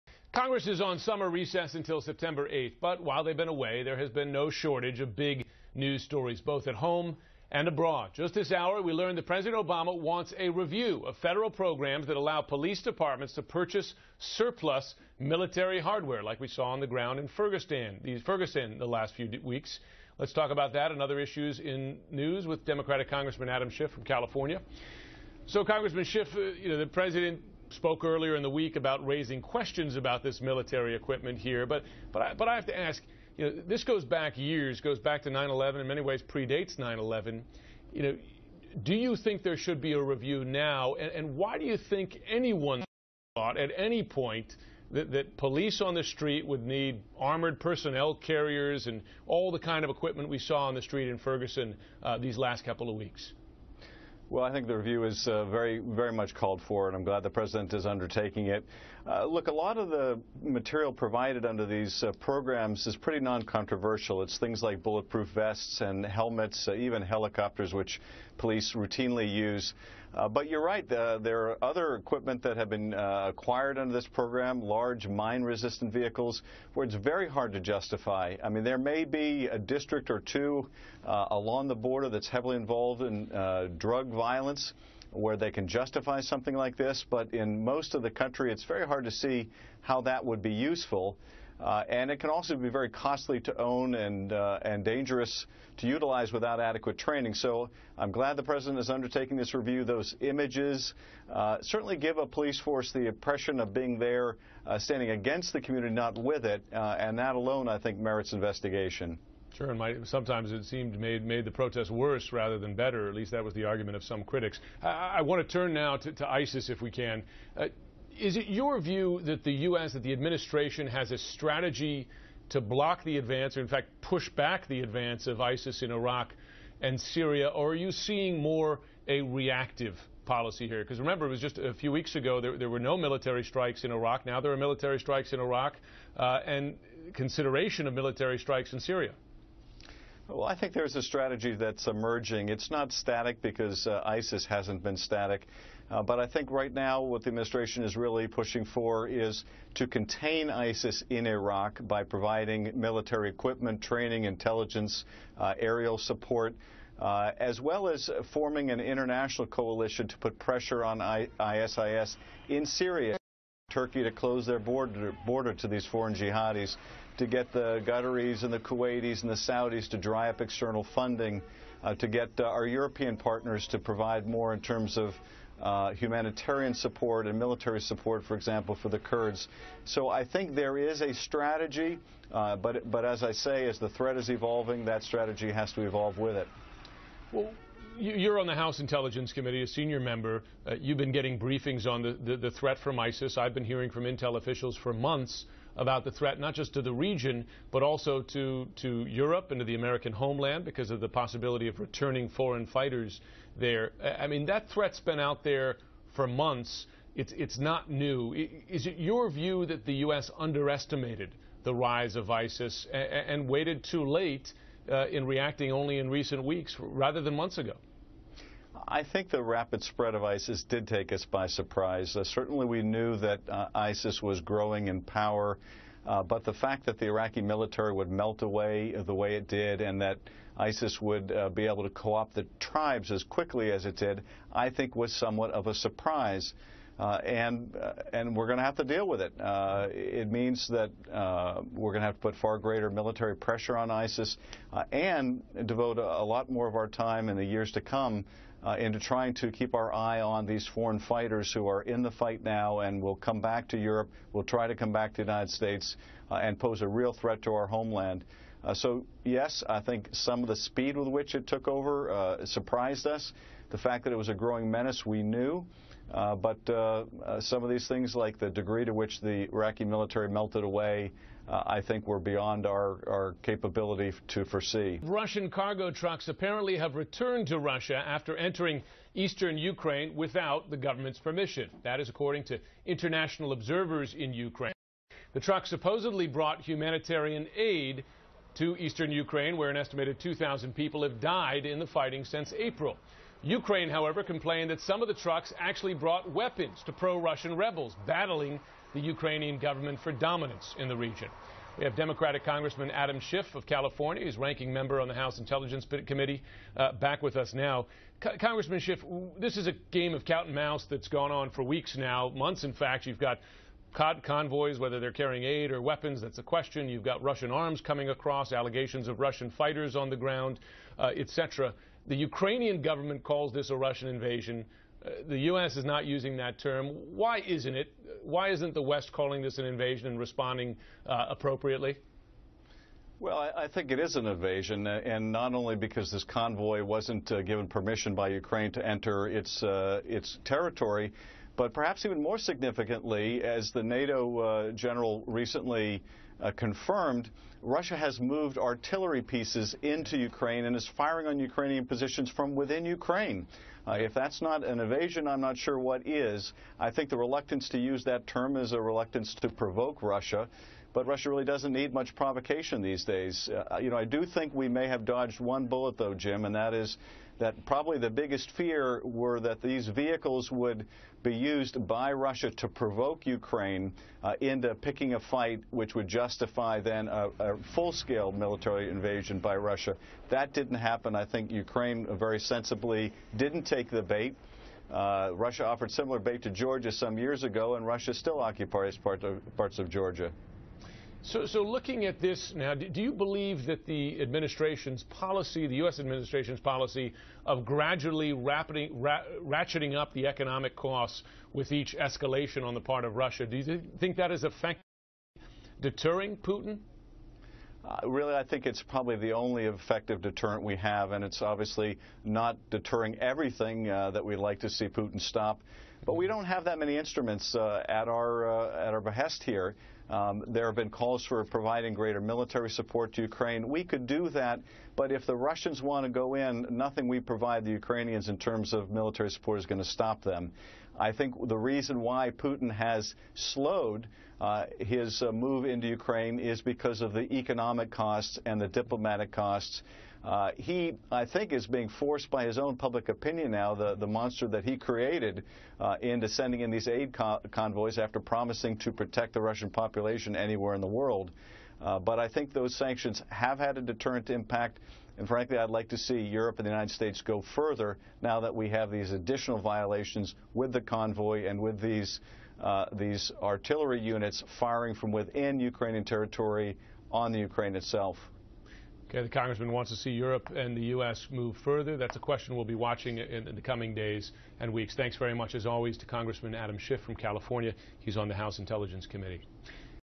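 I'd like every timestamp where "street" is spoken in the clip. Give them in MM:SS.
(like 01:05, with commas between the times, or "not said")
00:46, 00:50.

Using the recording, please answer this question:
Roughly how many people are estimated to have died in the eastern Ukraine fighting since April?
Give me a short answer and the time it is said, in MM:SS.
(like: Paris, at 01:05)
2,000, at 04:50.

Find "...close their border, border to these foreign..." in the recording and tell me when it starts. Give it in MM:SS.
02:44.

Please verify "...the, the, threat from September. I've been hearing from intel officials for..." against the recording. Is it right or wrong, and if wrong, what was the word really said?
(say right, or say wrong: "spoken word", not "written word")
wrong: "ISIS", not "September".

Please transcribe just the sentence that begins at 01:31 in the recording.
Uh, and it can also be very costly to own and, uh, and dangerous to utilize without adequate training.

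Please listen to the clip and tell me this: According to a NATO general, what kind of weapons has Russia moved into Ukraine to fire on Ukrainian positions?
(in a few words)
artillery pieces.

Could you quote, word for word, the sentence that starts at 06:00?
But Russia really doesn't need much provocation these days.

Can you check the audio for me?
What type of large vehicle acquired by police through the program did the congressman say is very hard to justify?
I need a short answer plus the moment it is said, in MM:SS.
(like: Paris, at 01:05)
mine-resistant vehicles, at 01:15.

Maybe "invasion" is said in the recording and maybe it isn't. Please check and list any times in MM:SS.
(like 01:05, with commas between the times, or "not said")
05:24, 05:29, 05:34, 05:54, 06:18.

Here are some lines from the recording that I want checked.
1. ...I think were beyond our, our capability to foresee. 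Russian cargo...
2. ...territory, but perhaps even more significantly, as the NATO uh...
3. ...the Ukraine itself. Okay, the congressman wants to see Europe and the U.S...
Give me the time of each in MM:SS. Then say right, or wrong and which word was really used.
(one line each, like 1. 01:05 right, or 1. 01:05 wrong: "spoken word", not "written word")
1. 04:31 right
2. 05:40 right
3. 07:47 right.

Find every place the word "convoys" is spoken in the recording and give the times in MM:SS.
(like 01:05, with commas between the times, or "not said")
05:13, 05:36, 07:27, 07:40.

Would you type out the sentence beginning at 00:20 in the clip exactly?
Let's talk about that and other issues in news with Democratic Congressman Adam Schiff from California.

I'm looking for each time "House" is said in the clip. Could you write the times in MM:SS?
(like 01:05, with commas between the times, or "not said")
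03:08, 05:05, 07:58.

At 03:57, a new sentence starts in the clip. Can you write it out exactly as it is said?
Uh, and uh, and we're going to have to deal with it.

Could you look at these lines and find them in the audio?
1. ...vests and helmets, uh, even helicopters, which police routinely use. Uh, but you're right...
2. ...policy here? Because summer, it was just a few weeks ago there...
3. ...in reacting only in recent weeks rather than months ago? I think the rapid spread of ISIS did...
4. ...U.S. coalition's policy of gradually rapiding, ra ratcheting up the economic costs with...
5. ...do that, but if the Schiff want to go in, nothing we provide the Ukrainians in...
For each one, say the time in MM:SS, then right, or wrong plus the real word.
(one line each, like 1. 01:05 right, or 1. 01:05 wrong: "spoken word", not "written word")
1. 01:05 right
2. 02:10 wrong: "remember", not "summer"
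3. 03:35 right
4. 06:35 wrong: "administration", not "coalition"
5. 07:04 wrong: "Russians", not "Schiff".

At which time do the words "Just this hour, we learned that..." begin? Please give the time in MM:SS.
00:08.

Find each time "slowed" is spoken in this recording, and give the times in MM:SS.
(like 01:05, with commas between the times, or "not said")
07:13.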